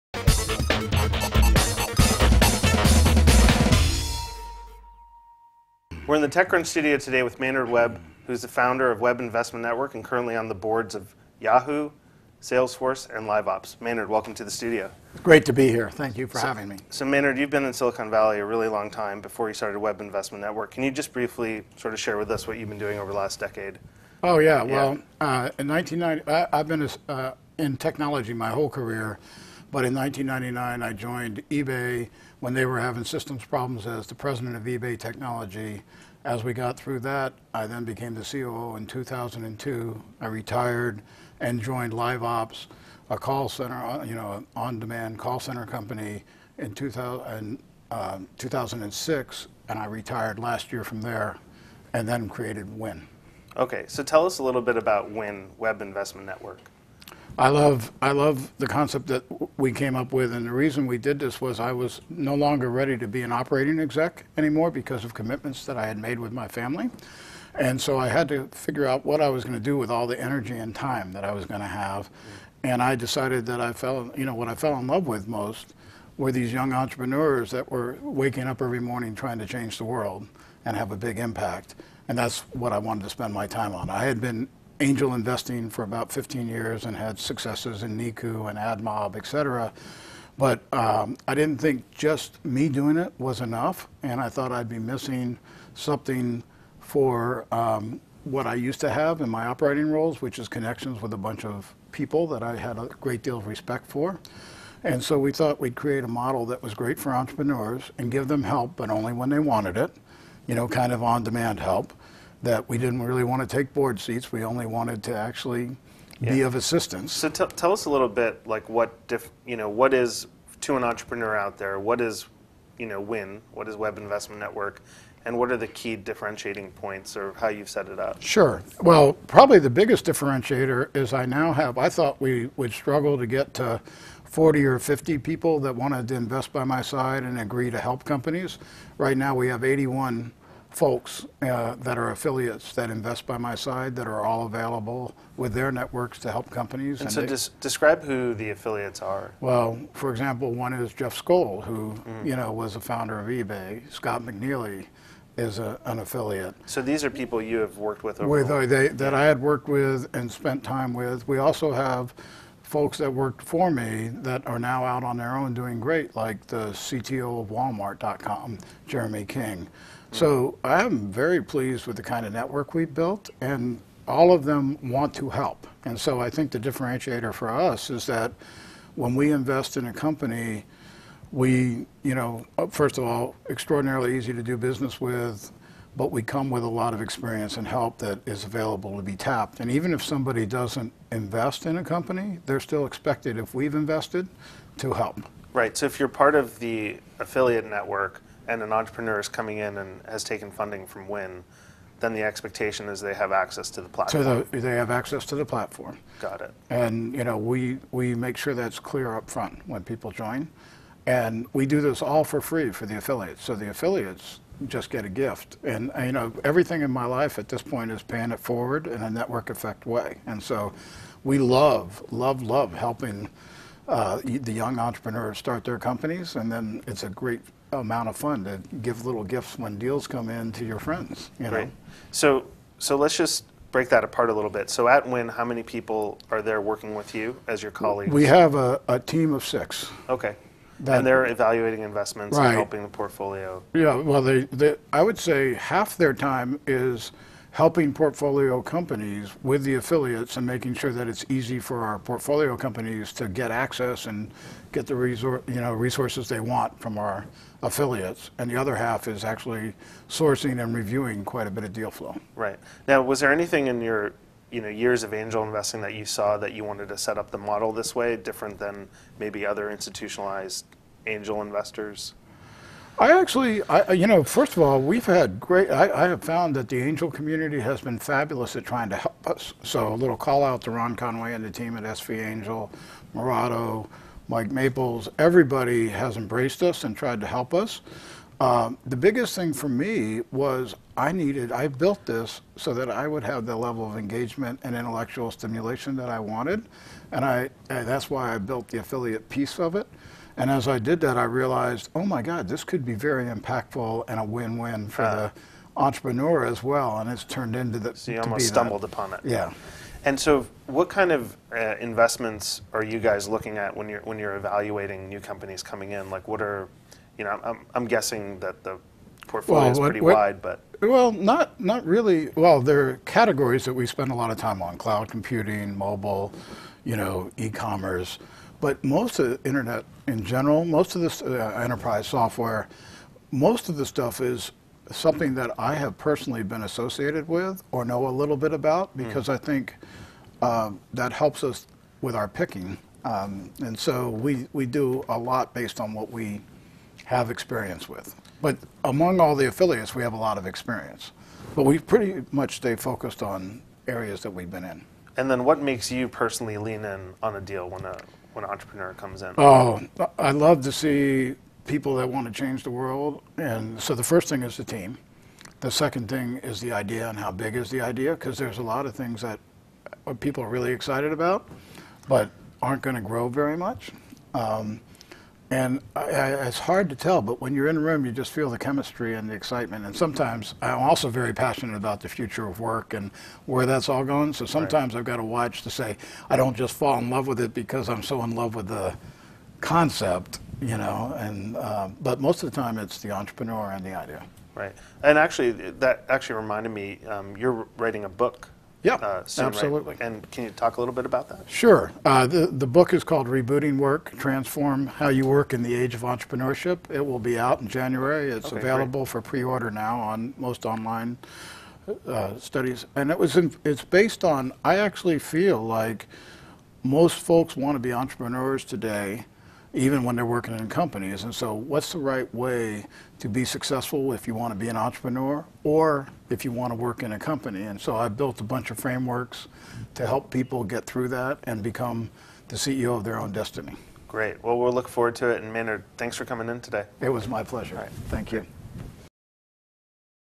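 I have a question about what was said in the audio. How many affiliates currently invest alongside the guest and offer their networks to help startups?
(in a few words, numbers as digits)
81.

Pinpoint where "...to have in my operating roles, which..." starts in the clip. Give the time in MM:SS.
01:38.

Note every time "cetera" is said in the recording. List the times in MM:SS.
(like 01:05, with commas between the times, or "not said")
01:29.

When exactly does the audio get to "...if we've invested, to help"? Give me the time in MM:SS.
03:13.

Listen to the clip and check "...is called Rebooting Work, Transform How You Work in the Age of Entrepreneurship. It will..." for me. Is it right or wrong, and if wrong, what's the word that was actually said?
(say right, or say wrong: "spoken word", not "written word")
right.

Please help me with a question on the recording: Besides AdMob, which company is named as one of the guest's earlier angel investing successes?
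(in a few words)
Niku.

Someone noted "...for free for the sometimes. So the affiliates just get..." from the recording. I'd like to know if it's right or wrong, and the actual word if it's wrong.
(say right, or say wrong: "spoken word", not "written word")
wrong: "affiliates", not "sometimes".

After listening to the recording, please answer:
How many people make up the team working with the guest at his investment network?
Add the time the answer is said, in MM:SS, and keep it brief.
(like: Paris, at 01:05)
6, at 03:59.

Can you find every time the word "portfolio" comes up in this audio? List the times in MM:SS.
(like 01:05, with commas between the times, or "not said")
04:02, 04:07, 04:11, 05:19.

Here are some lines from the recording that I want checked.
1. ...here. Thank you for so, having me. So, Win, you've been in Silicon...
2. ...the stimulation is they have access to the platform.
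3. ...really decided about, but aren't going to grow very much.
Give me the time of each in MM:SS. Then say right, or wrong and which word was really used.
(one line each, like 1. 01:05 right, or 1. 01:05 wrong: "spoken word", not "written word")
1. 00:15 wrong: "Maynard", not "Win"
2. 03:22 wrong: "expectation", not "stimulation"
3. 06:10 wrong: "excited", not "decided".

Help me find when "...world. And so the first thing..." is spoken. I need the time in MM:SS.
06:02.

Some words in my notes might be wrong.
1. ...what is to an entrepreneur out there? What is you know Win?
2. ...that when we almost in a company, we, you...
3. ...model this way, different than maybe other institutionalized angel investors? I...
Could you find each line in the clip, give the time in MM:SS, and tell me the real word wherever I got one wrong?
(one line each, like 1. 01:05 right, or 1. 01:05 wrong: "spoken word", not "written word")
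1. 01:59 right
2. 02:58 wrong: "invest", not "almost"
3. 04:27 right.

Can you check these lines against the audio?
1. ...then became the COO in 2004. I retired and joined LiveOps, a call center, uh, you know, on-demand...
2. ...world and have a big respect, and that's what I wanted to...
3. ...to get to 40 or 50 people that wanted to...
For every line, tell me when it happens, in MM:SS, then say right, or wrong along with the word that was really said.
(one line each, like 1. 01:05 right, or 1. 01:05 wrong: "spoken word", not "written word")
1. 00:37 wrong: "2002", not "2004"
2. 01:19 wrong: "impact", not "respect"
3. 02:13 right.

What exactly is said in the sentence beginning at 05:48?
But among all the affiliates, we have a lot of experience.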